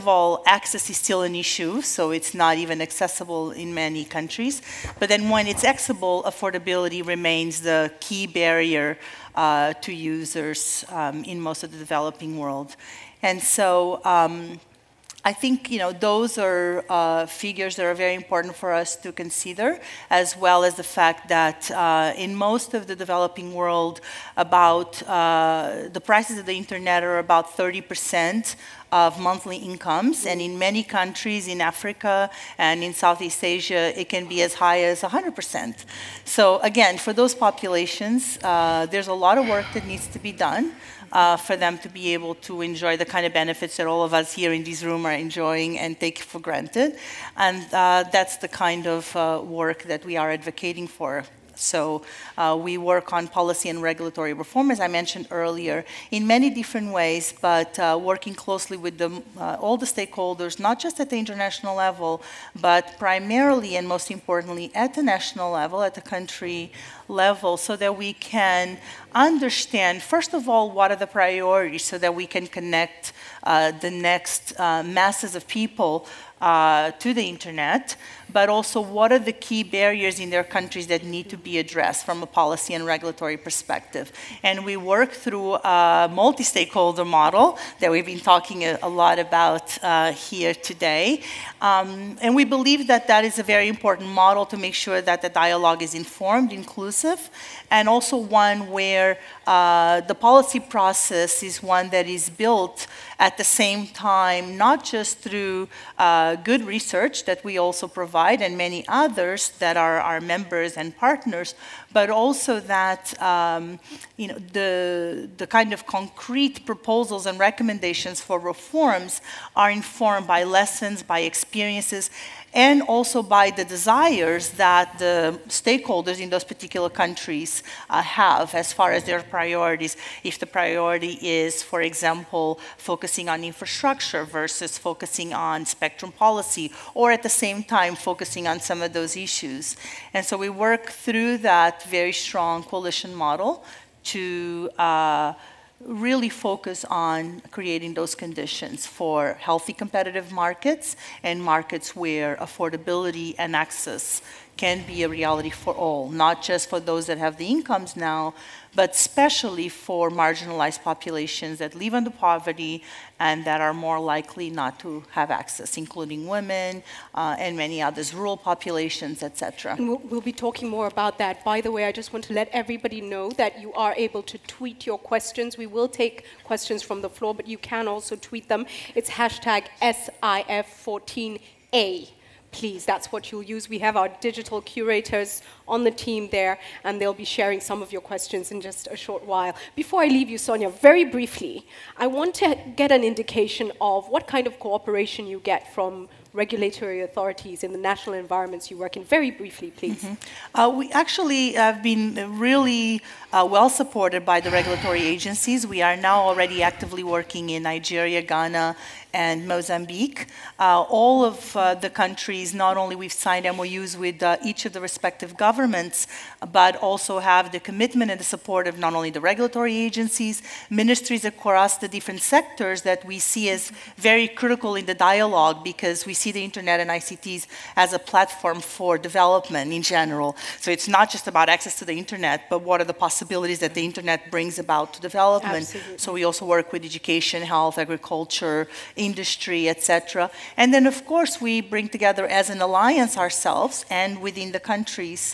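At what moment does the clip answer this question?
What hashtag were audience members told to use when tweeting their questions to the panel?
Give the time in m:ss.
2:59.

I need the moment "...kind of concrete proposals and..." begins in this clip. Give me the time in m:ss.
1:55.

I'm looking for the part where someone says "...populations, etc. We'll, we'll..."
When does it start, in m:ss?
2:48.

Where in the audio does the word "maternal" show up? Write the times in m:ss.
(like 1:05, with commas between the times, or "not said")
not said.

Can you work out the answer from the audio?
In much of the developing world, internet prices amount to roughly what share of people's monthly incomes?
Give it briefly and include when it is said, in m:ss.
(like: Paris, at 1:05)
30 percent, at 0:27.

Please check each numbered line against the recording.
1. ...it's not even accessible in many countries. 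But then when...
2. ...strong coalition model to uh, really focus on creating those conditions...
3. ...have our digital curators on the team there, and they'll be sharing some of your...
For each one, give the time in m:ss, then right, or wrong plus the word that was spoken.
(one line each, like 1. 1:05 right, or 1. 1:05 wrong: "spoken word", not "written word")
1. 0:02 right
2. 2:22 right
3. 3:03 right.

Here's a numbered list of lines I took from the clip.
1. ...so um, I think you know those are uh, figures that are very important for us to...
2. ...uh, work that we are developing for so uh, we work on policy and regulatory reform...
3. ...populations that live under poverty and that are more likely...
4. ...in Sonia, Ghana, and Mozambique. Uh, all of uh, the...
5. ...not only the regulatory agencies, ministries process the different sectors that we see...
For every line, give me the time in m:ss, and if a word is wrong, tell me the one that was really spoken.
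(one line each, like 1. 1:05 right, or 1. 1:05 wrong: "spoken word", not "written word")
1. 0:13 right
2. 0:49 wrong: "advocating", not "developing"
3. 2:40 right
4. 3:27 wrong: "Nigeria", not "Sonia"
5. 3:38 wrong: "across", not "process".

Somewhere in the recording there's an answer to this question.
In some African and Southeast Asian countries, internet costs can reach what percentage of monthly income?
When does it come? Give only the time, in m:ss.
0:35.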